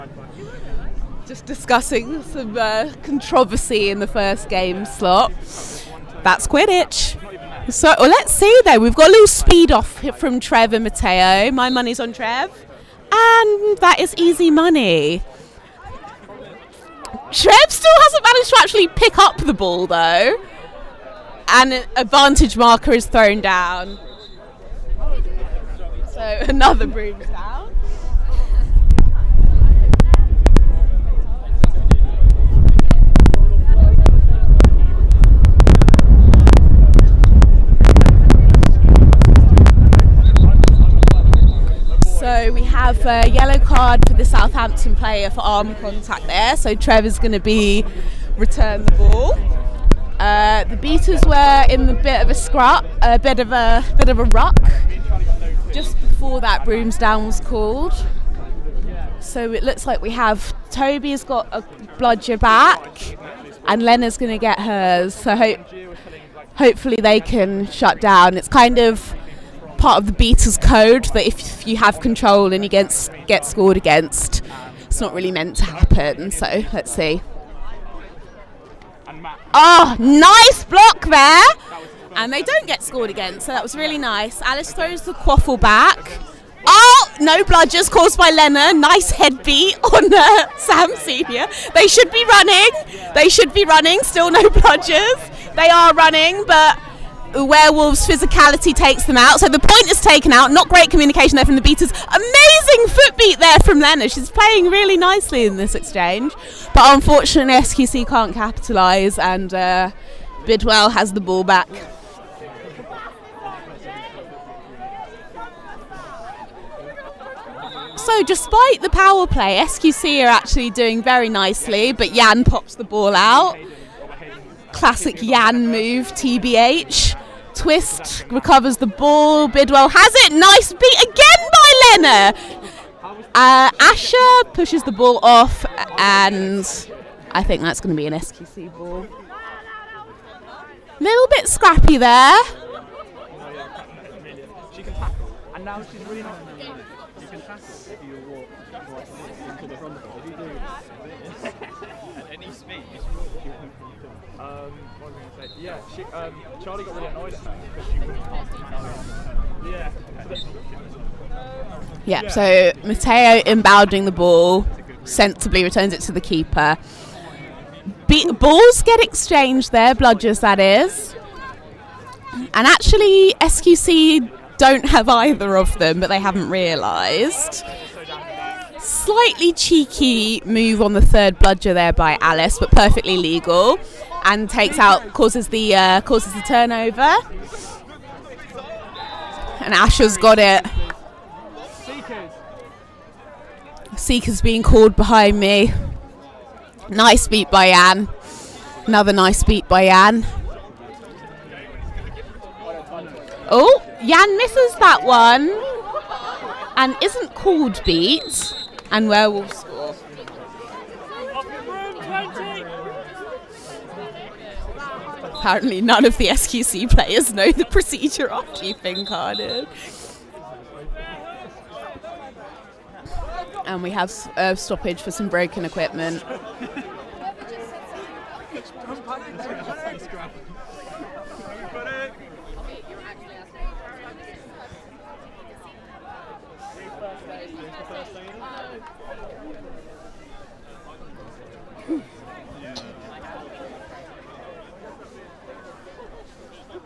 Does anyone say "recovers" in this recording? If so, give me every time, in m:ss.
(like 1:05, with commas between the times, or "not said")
2:08.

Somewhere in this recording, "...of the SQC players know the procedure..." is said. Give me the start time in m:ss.
3:36.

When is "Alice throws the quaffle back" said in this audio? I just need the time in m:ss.
1:24.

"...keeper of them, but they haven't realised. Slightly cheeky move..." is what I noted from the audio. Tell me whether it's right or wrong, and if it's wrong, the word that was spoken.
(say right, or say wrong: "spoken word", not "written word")
wrong: "either", not "keeper".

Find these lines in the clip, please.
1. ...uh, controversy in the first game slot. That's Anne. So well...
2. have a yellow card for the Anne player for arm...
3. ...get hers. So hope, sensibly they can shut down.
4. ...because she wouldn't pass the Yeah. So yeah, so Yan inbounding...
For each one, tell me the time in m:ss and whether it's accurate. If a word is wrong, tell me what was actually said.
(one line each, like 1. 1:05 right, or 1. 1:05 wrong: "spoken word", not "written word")
1. 0:02 wrong: "Quidditch", not "Anne"
2. 0:42 wrong: "Southampton", not "Anne"
3. 1:04 wrong: "hopefully", not "sensibly"
4. 2:37 wrong: "Mateo", not "Yan".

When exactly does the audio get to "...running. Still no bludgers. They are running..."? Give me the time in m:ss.
1:33.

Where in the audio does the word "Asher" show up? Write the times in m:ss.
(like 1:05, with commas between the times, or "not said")
2:13, 3:09.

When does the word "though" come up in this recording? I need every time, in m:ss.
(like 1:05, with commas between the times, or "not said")
0:08, 0:19.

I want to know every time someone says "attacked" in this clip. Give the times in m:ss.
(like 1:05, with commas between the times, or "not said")
not said.